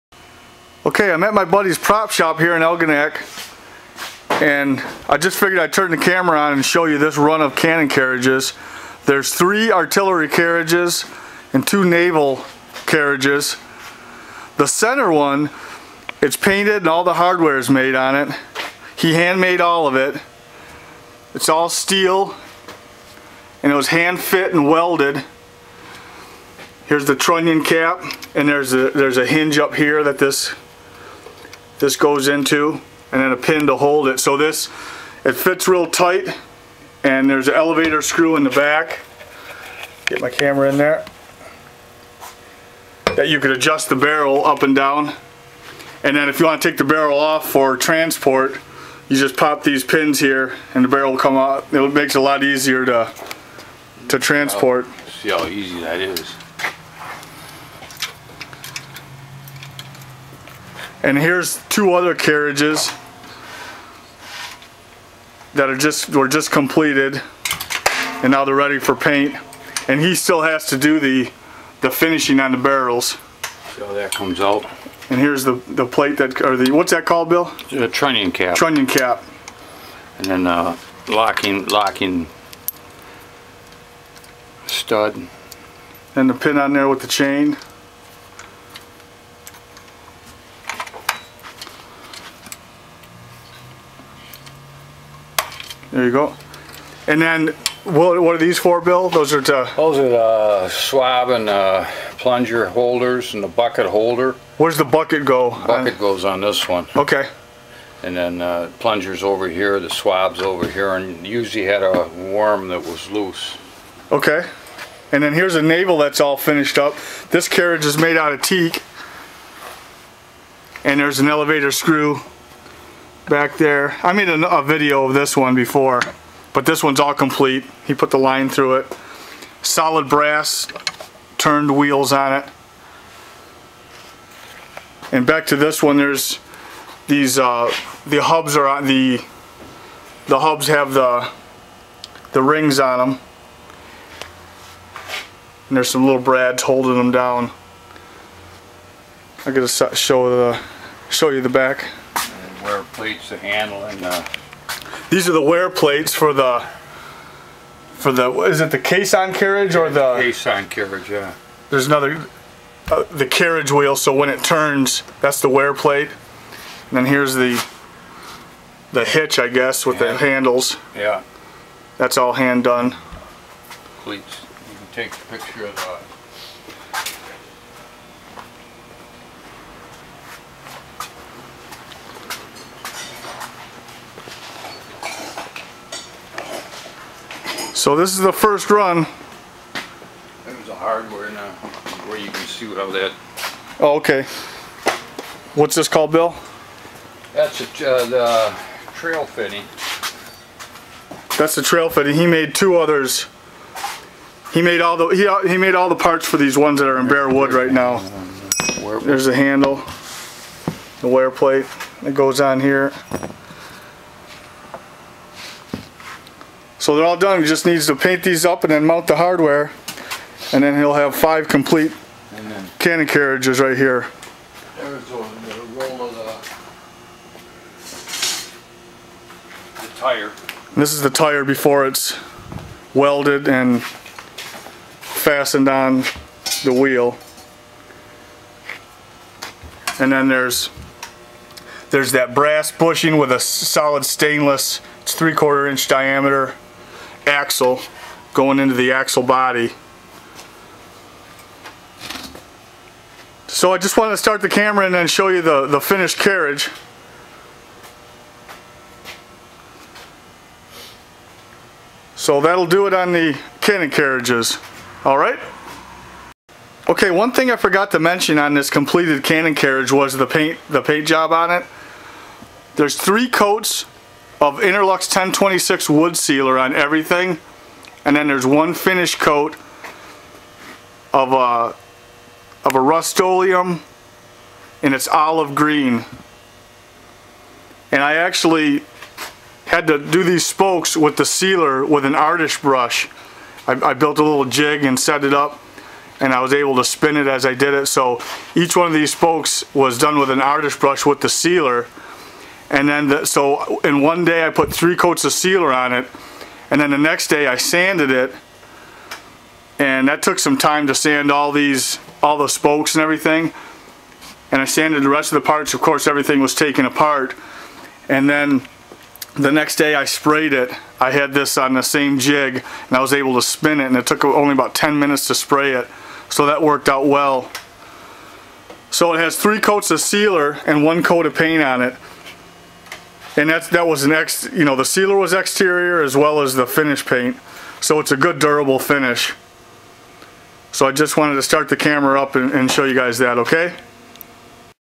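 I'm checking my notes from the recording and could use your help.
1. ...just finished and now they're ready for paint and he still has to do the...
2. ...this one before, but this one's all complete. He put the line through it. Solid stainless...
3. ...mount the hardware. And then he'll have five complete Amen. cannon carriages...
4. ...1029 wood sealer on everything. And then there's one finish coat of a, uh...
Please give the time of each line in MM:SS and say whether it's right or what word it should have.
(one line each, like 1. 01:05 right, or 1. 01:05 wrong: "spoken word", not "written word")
1. 01:06 wrong: "completed", not "finished"
2. 02:05 wrong: "brass", not "stainless"
3. 03:38 right
4. 04:35 wrong: "1026", not "1029".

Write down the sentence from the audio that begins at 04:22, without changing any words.
So that'll do it on the Cannon carriages.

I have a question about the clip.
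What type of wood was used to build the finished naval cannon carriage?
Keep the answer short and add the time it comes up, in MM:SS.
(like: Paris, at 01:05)
teak, at 01:58.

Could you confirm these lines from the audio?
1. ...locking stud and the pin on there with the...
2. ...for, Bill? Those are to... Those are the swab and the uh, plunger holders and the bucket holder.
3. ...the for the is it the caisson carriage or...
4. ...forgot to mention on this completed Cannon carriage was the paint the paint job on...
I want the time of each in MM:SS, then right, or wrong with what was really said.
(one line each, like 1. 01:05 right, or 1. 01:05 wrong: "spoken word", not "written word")
1. 01:21 right
2. 01:38 right
3. 02:36 right
4. 04:27 right.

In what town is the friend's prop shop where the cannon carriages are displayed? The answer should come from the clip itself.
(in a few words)
Algonac.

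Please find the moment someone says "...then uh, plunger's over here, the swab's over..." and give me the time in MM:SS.
01:48.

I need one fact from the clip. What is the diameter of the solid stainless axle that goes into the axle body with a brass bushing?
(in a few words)
3/4 inch.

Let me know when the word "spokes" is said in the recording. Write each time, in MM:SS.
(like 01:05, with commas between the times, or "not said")
04:50, 04:59, 05:12.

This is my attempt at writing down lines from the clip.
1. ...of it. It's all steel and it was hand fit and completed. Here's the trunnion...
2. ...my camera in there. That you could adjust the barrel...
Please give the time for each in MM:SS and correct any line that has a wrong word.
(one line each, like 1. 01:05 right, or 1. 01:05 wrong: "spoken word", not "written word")
1. 00:19 wrong: "welded", not "completed"
2. 00:40 right.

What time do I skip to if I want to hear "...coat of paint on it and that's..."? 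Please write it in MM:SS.
05:31.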